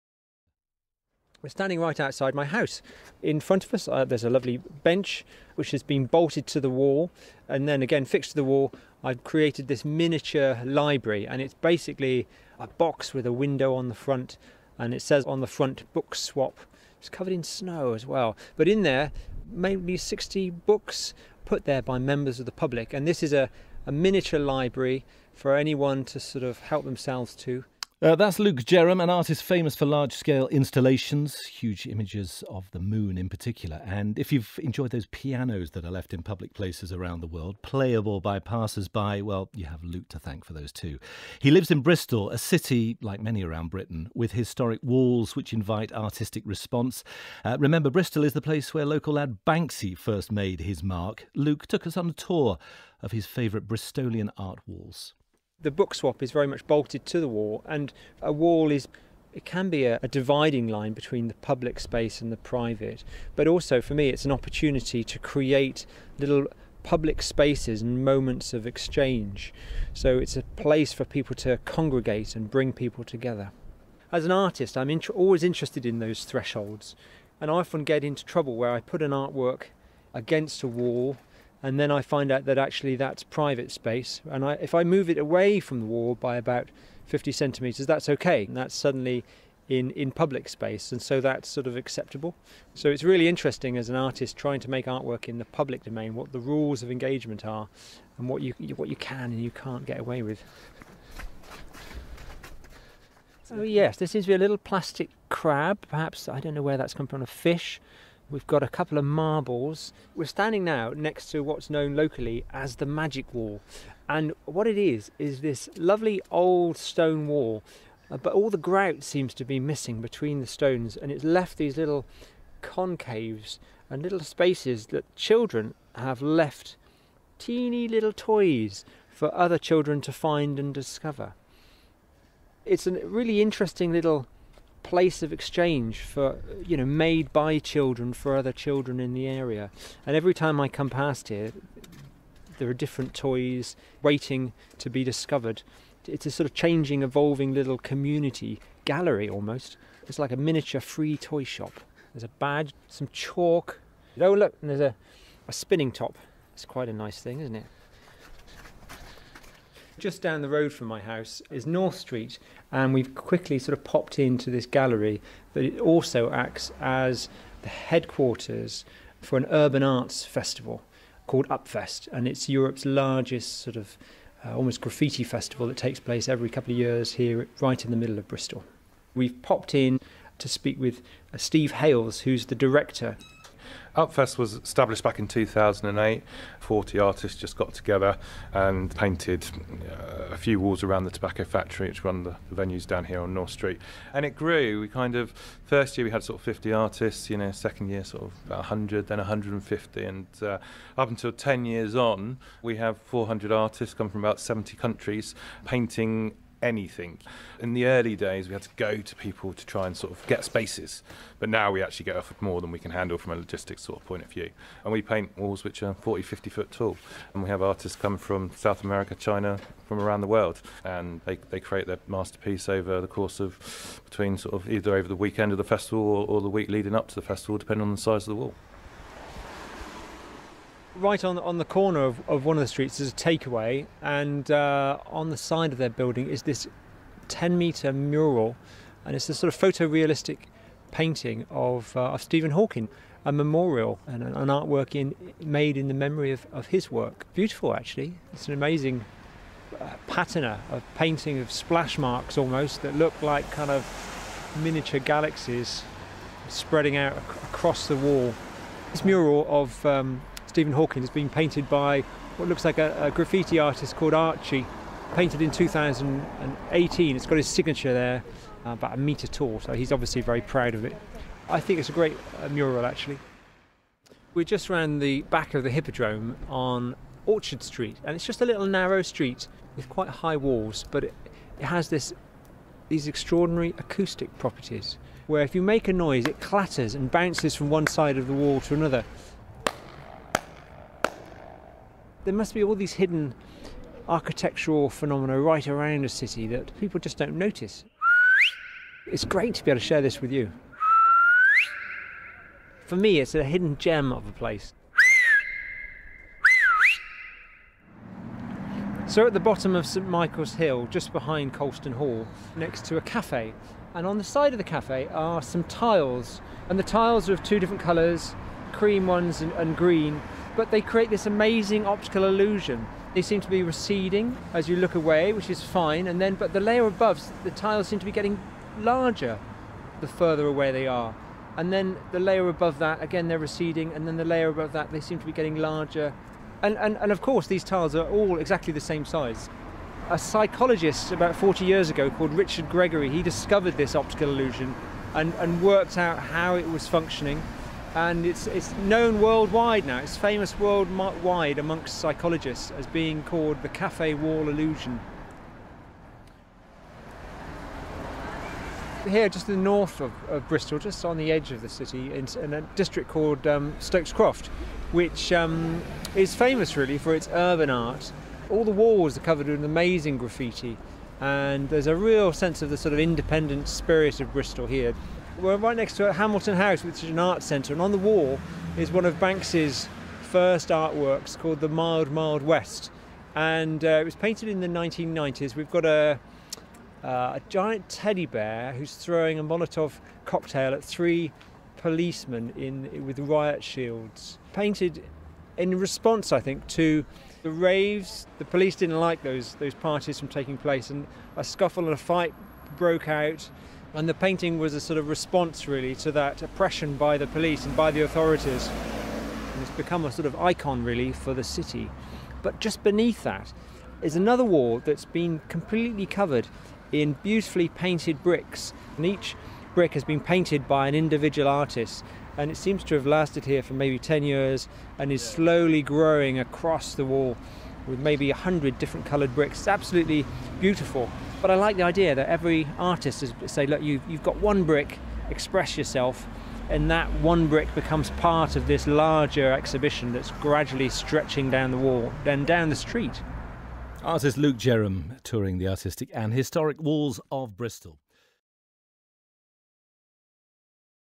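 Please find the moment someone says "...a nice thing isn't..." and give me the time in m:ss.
2:36.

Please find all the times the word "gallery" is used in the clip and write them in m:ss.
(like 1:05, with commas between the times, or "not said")
2:28, 2:44.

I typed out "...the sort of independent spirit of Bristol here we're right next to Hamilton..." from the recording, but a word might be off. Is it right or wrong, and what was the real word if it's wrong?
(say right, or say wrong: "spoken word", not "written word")
right.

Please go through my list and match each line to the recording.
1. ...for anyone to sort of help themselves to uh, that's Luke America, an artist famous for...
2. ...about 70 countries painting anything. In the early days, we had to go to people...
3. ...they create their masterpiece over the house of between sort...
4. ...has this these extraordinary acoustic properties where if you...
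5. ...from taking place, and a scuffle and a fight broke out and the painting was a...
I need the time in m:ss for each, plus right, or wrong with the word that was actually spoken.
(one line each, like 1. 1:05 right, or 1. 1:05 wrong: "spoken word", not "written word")
1. 0:25 wrong: "Jerram", not "America"
2. 3:24 right
3. 3:41 wrong: "course", not "house"
4. 4:41 right
5. 6:40 right.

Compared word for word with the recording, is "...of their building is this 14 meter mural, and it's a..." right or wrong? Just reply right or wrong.
wrong.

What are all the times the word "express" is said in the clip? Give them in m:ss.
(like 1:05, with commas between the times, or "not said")
7:15.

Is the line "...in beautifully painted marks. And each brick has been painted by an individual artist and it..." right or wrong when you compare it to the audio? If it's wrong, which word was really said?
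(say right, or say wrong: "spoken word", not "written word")
wrong: "bricks", not "marks".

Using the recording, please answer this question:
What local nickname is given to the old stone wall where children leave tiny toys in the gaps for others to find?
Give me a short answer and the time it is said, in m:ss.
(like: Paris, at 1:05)
Magic Wall, at 1:52.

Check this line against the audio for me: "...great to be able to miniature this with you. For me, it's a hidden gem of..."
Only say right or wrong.
wrong.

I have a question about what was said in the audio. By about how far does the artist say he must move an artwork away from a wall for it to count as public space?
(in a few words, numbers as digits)
50 centimetres.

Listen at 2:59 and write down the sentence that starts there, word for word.
We've popped in to speak with uh, Steve Hayles, who's the director Upfest was established back in 2008.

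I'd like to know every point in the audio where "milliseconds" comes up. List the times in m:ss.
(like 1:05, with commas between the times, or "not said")
not said.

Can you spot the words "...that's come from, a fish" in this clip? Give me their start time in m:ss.
1:46.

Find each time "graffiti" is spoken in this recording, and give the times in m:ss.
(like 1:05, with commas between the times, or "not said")
2:54, 4:23, 6:10.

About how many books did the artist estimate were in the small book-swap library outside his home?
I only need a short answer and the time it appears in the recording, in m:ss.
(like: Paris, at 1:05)
60, at 0:19.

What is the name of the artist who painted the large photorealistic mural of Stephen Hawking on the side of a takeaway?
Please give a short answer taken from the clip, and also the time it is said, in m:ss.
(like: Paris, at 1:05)
Archie, at 4:24.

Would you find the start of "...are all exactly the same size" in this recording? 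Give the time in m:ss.
5:37.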